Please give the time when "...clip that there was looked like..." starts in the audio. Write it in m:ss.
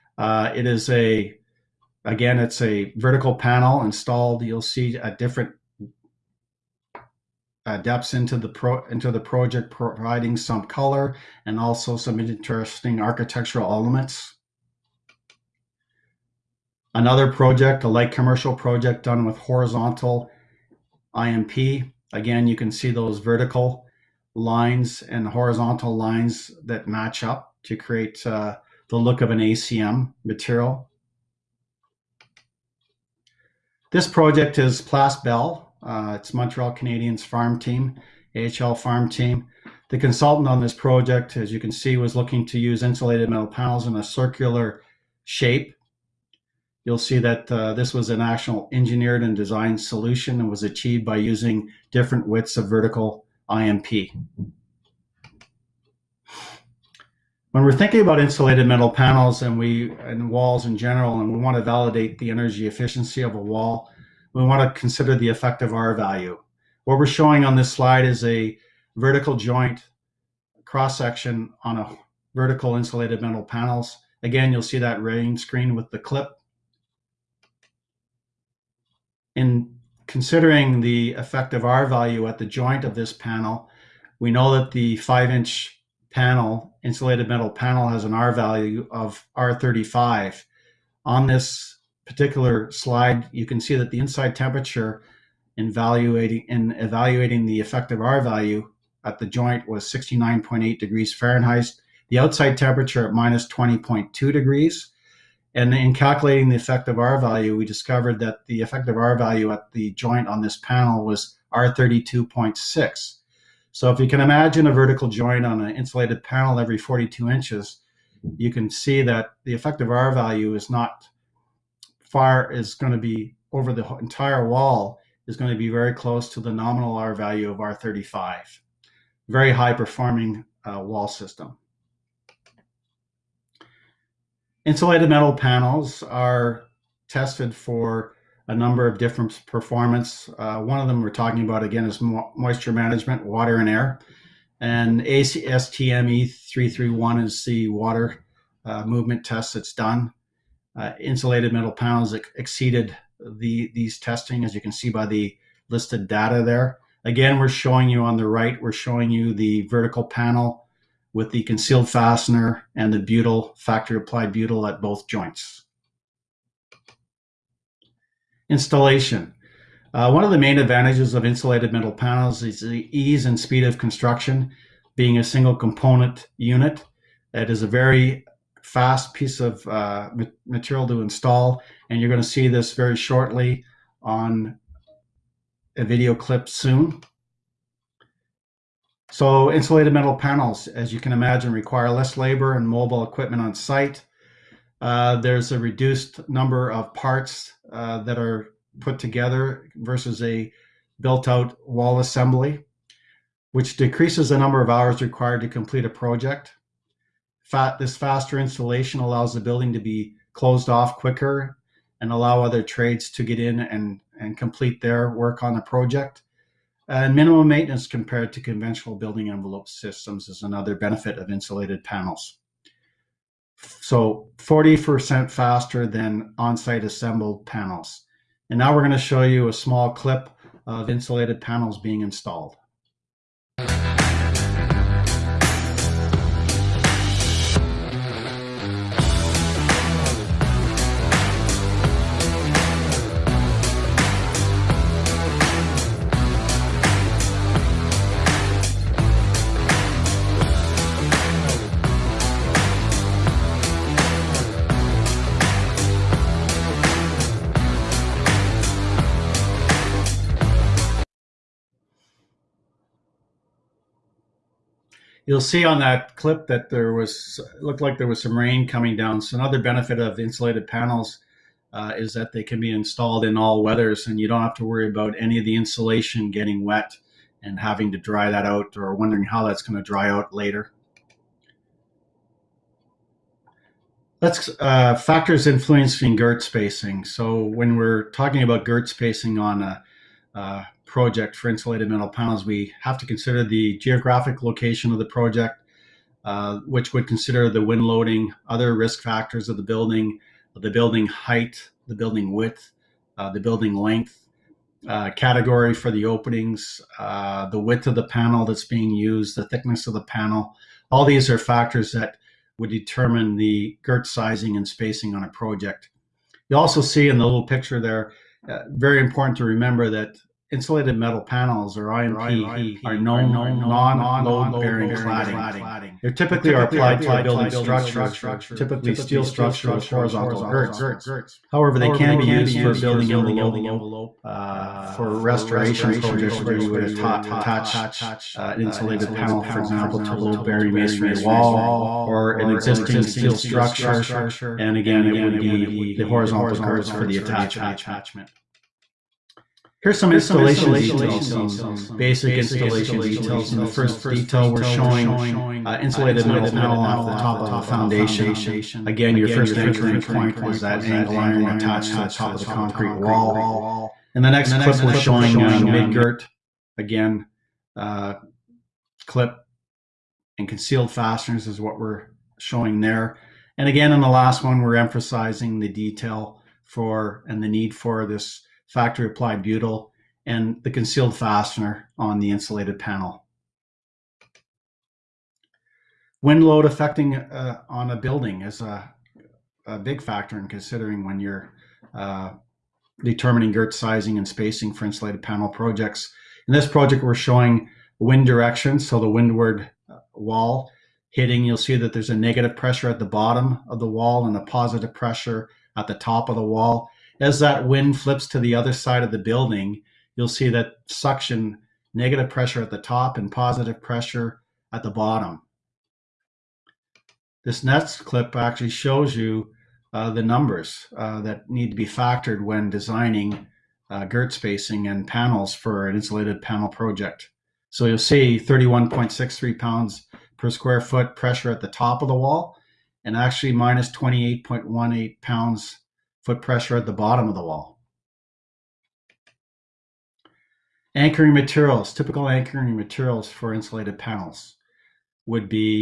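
4:26.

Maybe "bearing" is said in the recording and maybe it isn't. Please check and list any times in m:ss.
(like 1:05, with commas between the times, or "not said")
5:24, 5:40.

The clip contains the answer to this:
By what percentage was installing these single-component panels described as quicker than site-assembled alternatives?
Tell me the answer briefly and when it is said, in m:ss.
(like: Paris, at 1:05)
40%, at 3:44.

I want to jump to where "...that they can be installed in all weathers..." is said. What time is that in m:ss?
4:32.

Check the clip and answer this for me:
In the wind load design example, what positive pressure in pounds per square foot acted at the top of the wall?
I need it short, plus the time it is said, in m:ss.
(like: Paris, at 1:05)
31.63, at 7:08.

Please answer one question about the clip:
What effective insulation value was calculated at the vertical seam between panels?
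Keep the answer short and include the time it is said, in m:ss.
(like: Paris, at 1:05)
R32.6, at 1:51.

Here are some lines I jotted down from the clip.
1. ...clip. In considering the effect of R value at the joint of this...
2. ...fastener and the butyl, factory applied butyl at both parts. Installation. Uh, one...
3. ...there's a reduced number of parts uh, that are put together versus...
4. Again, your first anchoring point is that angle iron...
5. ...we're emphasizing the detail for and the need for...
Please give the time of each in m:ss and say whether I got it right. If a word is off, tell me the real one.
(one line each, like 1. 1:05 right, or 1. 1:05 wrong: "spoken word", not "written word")
1. 1:15 right
2. 2:41 wrong: "joints", not "parts"
3. 3:15 right
4. 5:58 right
5. 6:14 right.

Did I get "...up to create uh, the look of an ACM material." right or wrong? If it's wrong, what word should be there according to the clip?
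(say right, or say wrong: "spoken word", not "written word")
right.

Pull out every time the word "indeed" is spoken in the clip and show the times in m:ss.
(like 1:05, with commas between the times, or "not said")
not said.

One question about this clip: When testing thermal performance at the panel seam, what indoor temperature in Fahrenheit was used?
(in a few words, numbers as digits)
69.8 degrees.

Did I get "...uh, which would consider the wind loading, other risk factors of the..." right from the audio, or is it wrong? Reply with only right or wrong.
right.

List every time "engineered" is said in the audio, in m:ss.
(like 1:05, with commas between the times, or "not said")
0:48.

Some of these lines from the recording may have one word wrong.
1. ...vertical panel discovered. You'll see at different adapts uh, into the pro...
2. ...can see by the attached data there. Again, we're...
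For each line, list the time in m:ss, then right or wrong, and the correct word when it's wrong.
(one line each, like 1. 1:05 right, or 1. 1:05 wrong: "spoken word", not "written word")
1. 0:02 wrong: "installed", not "discovered"
2. 2:34 wrong: "listed", not "attached".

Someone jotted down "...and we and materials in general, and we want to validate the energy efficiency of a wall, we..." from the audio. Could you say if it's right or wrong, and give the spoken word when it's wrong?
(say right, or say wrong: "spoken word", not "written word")
wrong: "walls", not "materials".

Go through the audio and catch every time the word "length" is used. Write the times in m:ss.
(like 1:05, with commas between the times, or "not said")
5:03.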